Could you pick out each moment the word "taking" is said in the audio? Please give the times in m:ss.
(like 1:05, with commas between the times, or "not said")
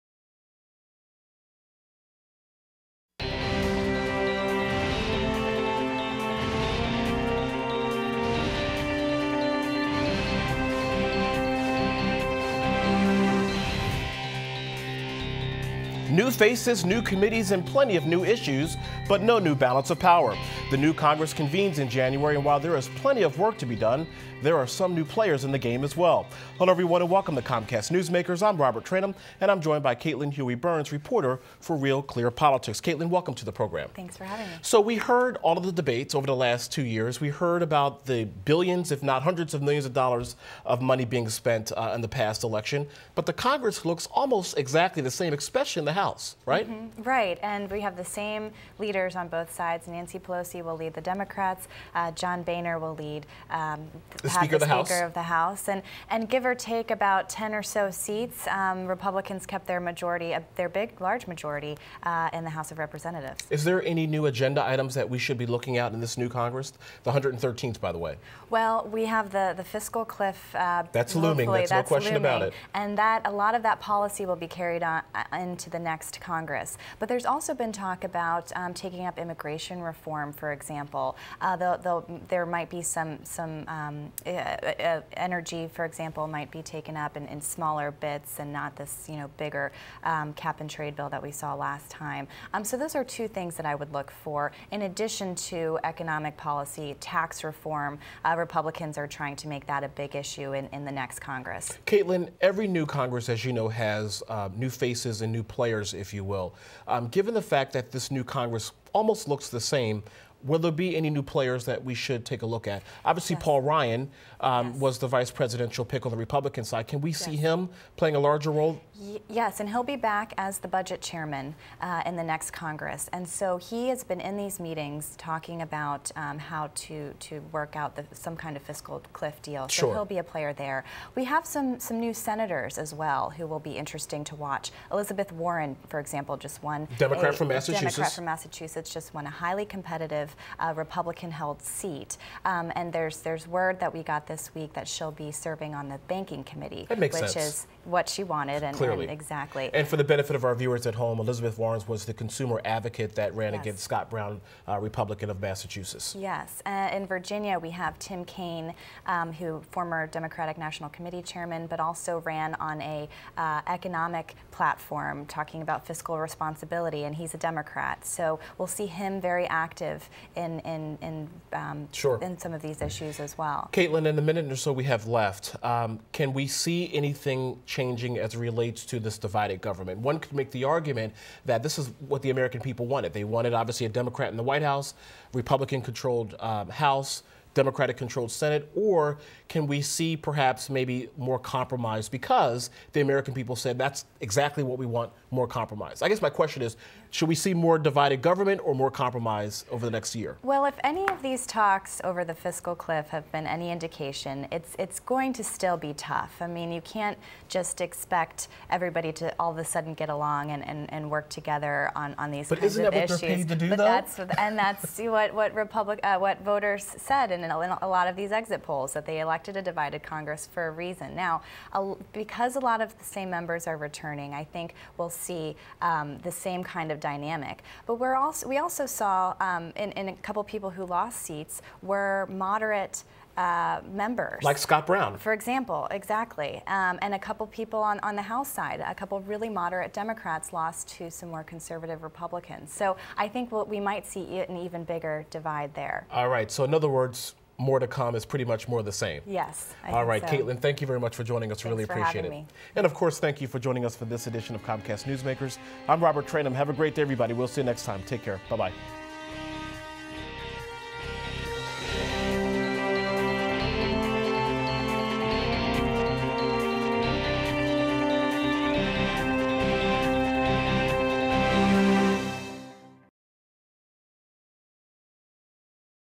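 1:18.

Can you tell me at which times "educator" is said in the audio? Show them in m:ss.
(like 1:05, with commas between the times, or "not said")
not said.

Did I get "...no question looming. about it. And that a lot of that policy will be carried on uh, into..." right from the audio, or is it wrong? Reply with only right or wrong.
right.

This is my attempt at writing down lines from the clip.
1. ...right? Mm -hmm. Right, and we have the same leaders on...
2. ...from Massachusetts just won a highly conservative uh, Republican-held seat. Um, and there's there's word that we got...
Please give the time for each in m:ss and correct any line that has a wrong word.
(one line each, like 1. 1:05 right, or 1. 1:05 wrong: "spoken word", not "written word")
1. 0:46 right
2. 2:18 wrong: "competitive", not "conservative".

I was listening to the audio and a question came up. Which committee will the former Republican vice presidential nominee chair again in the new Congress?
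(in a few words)
Budget chairman.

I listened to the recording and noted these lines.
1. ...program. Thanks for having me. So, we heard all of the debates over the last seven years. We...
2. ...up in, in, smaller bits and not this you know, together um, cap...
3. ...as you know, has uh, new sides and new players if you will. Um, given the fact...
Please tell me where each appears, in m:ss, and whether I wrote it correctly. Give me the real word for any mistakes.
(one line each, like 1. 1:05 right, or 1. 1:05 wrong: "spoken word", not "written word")
1. 0:33 wrong: "two", not "seven"
2. 1:26 wrong: "bigger", not "together"
3. 1:43 wrong: "faces", not "sides".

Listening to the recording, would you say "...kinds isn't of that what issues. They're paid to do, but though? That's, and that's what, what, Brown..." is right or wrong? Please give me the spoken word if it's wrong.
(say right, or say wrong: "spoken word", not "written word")
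wrong: "Republic", not "Brown".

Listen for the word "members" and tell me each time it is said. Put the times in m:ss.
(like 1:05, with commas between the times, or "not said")
3:43, 3:53.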